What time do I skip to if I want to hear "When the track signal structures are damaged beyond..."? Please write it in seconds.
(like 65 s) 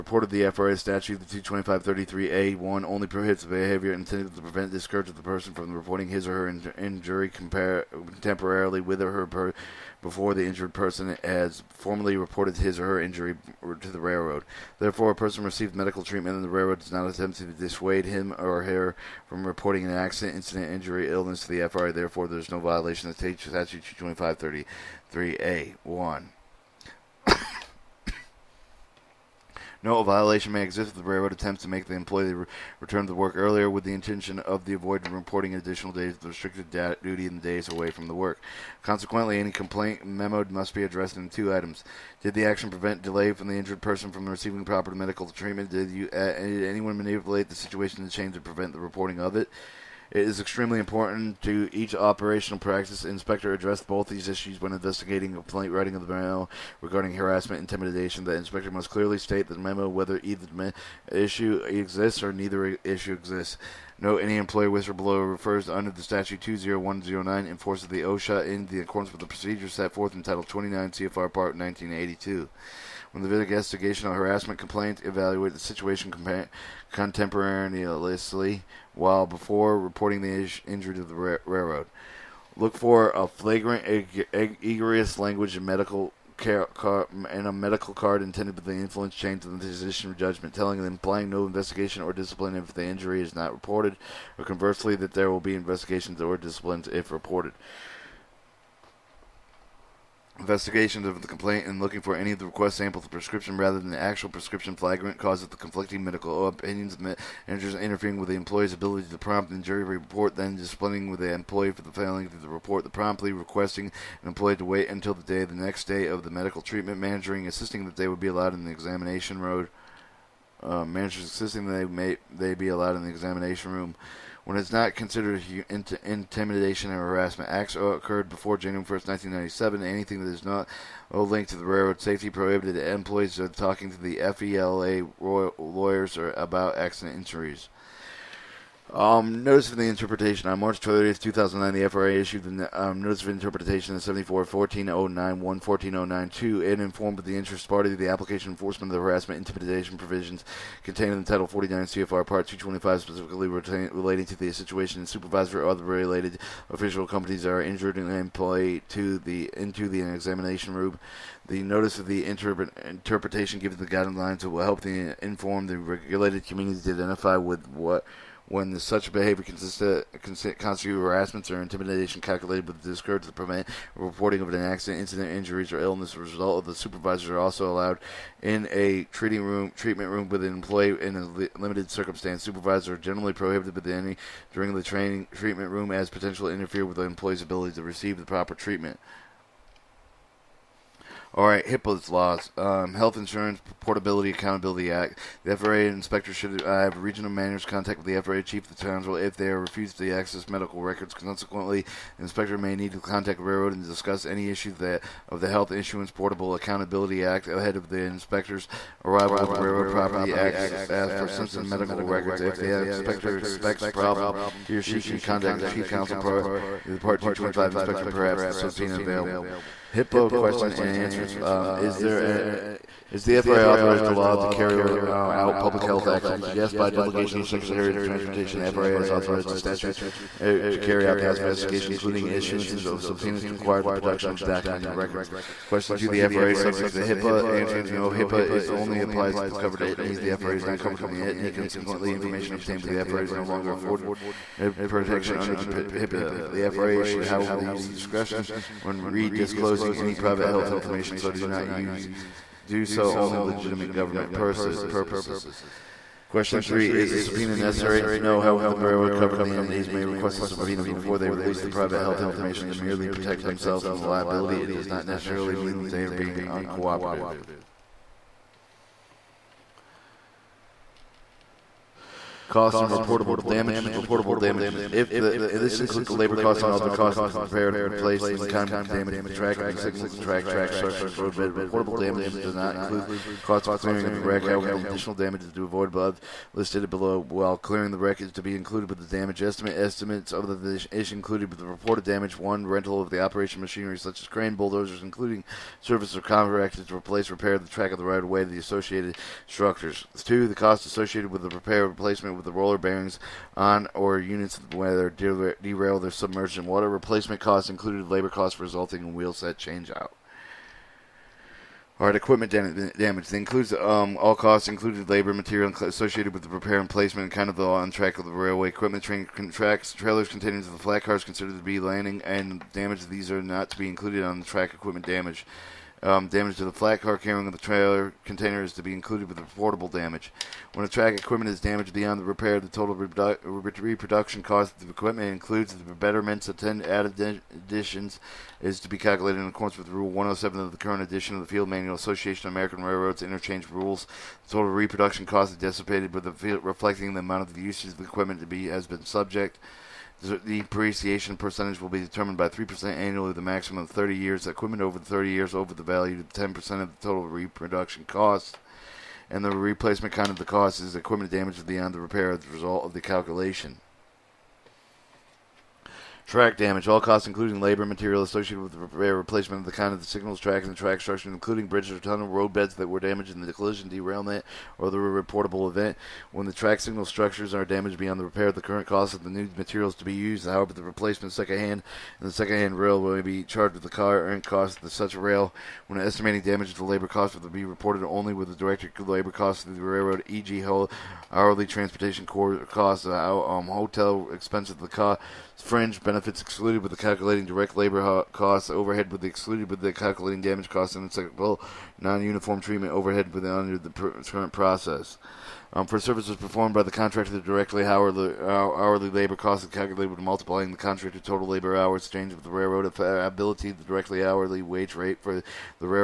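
376 s.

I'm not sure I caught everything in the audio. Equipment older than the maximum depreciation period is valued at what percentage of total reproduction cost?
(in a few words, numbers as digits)
10%.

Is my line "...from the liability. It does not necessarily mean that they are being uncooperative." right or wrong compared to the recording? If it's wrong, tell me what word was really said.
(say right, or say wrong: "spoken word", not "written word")
right.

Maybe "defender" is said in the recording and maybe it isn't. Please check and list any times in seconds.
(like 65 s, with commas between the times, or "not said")
not said.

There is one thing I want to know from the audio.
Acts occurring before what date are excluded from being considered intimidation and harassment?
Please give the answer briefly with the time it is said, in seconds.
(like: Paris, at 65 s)
January 1, 1997, at 128 s.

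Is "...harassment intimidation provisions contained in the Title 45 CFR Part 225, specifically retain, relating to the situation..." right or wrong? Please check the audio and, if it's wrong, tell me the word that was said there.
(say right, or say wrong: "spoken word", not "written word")
wrong: "49", not "45".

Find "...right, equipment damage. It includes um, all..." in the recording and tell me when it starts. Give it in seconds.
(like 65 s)
312 s.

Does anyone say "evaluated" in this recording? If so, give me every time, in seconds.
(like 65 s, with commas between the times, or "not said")
75 s.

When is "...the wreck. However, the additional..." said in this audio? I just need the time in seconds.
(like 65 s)
284 s.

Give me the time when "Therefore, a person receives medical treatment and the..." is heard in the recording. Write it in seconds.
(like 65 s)
14 s.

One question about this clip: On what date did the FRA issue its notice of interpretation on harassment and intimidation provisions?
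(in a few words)
March 30, 2009.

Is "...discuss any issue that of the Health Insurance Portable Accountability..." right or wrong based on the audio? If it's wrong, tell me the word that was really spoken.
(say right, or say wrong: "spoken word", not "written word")
right.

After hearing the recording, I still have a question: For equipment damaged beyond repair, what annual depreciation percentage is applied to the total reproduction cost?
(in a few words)
3%.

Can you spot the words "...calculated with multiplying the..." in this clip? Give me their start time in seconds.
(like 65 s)
409 s.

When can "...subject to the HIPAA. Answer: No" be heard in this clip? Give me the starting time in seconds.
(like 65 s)
236 s.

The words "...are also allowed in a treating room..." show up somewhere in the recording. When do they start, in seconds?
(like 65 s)
177 s.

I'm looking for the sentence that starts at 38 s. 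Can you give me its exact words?
Consequently, any complaint memoed must be addressed in two items.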